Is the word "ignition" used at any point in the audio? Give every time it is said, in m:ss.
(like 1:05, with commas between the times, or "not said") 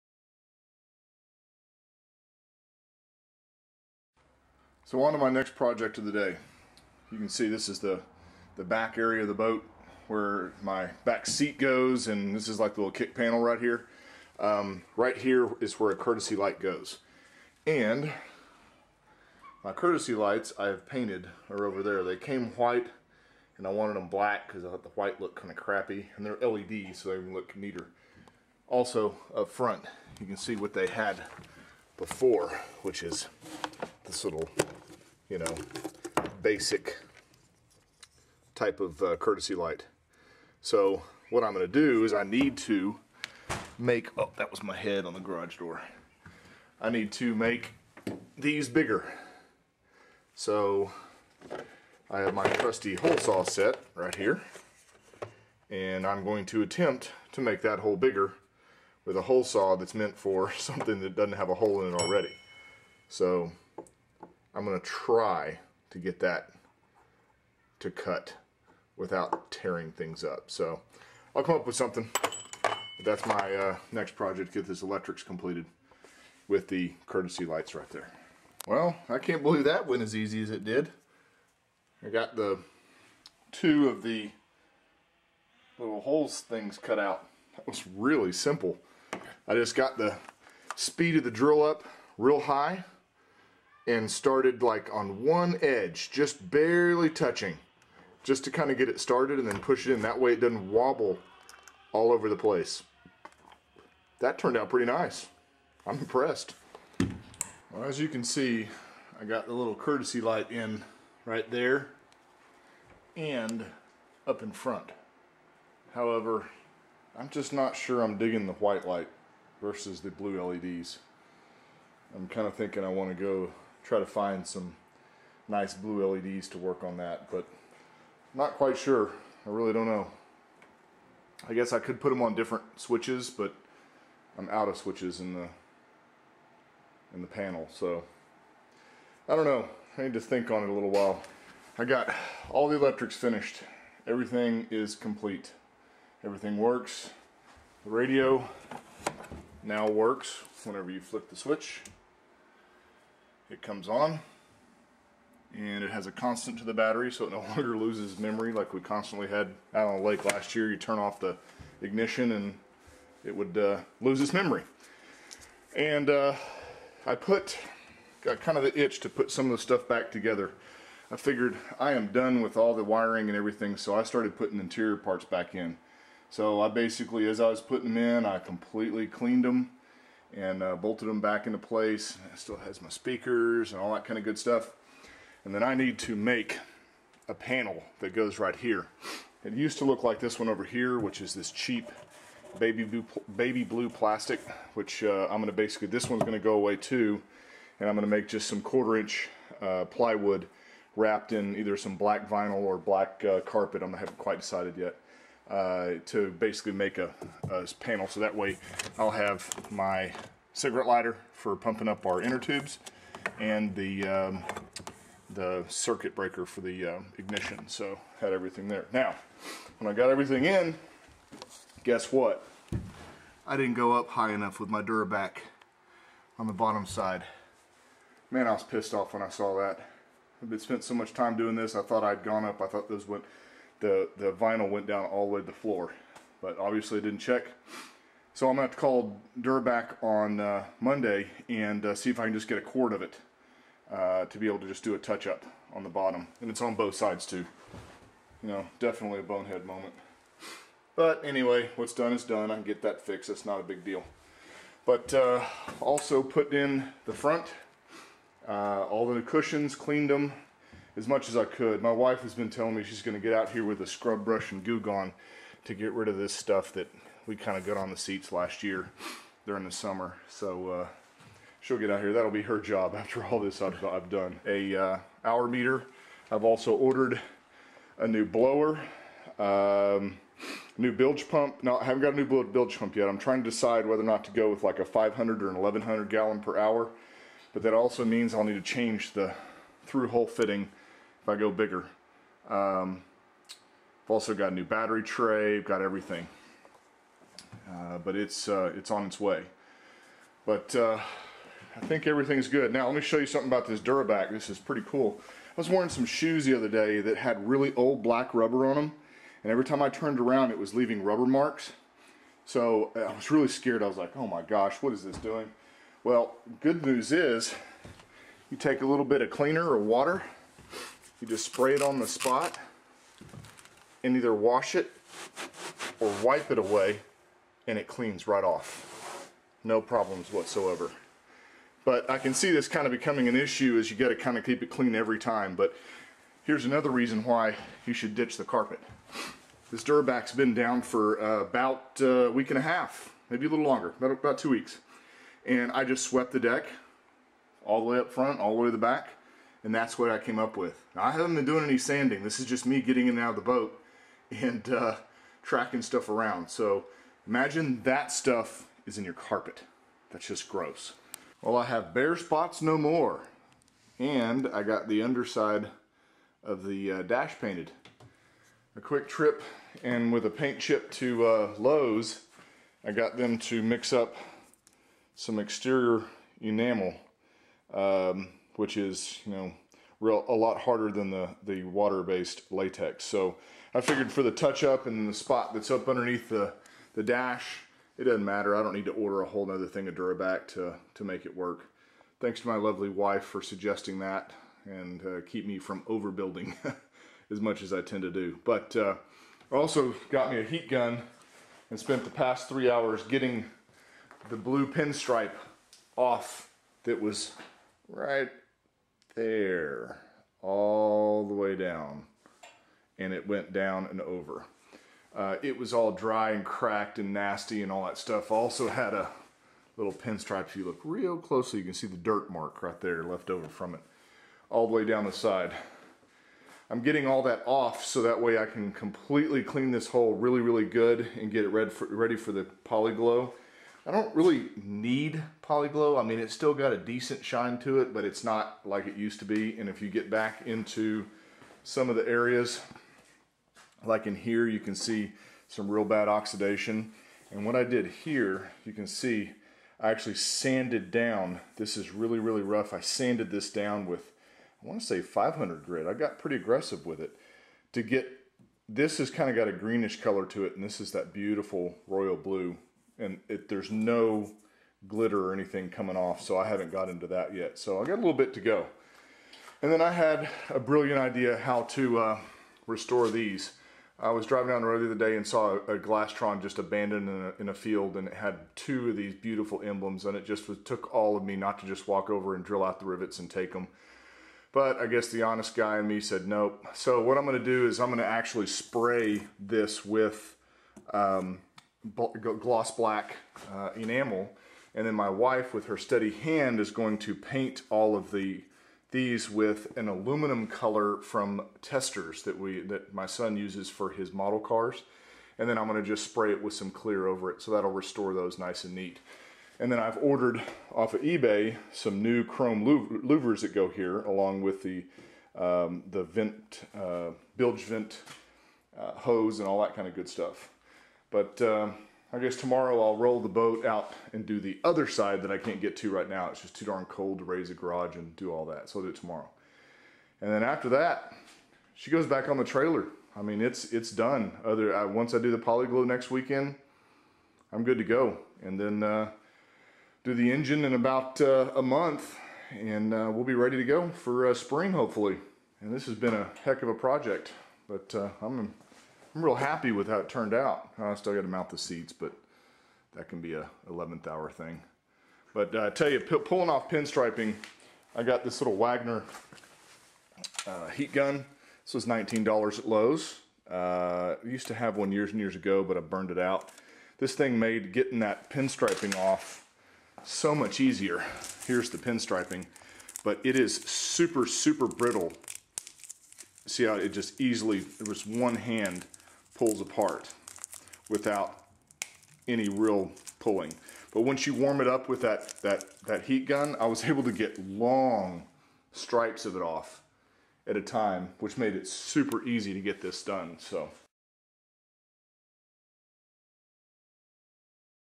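2:41, 3:37.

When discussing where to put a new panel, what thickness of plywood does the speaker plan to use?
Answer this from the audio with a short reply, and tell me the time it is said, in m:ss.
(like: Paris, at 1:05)
quarter inch, at 3:18.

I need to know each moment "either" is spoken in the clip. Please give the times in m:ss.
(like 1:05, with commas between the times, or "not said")
3:21, 5:24.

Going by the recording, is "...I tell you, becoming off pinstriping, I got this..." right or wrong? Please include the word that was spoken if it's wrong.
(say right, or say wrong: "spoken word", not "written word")
wrong: "pulling", not "becoming".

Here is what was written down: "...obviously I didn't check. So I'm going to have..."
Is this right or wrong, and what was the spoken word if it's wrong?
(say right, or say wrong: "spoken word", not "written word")
right.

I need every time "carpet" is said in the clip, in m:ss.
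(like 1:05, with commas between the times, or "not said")
3:23, 5:38, 5:59.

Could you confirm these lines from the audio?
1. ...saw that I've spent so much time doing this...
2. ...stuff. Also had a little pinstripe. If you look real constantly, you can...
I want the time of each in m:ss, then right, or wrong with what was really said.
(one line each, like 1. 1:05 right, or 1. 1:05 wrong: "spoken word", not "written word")
1. 3:49 right
2. 6:57 wrong: "closely", not "constantly".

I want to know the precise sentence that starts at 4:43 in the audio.
I'm trying to decide whether or not to go with like a 500 or an 1100 gallon per hour.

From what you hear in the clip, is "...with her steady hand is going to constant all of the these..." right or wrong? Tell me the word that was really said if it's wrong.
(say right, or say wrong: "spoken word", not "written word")
wrong: "paint", not "constant".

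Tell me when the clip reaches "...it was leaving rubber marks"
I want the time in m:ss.
5:10.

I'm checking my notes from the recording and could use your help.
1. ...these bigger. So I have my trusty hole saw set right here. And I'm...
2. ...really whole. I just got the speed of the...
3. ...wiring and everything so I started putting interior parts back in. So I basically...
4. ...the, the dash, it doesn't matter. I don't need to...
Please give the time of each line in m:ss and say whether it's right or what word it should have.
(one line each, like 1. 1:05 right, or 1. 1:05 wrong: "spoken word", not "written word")
1. 0:48 right
2. 1:27 wrong: "simple", not "whole"
3. 2:52 right
4. 6:26 right.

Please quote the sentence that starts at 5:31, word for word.
But I can see this kind of becoming an issue as you got to kind of keep it clean every time.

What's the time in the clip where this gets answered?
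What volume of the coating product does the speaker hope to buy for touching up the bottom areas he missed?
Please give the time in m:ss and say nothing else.
4:02.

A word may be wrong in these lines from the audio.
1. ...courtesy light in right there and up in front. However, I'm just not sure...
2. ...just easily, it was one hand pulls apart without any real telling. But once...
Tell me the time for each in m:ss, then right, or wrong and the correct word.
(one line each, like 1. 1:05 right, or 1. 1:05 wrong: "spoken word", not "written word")
1. 1:49 right
2. 9:36 wrong: "pulling", not "telling".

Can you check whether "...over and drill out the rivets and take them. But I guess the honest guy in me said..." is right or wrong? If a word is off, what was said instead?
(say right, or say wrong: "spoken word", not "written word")
right.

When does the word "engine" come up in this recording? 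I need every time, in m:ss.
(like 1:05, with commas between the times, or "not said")
9:00.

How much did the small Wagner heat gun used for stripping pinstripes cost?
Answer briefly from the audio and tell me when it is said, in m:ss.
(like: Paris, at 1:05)
$19, at 9:21.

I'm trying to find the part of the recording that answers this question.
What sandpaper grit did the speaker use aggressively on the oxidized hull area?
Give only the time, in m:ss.
7:35.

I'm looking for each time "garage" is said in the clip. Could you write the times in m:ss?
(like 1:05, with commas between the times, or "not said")
0:45, 8:47.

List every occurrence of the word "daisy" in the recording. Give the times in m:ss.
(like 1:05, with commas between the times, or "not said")
not said.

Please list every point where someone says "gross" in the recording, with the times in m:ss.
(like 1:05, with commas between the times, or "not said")
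6:00.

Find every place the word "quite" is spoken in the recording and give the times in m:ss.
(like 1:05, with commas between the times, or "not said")
2:08, 3:24.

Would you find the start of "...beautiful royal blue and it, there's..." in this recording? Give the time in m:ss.
7:41.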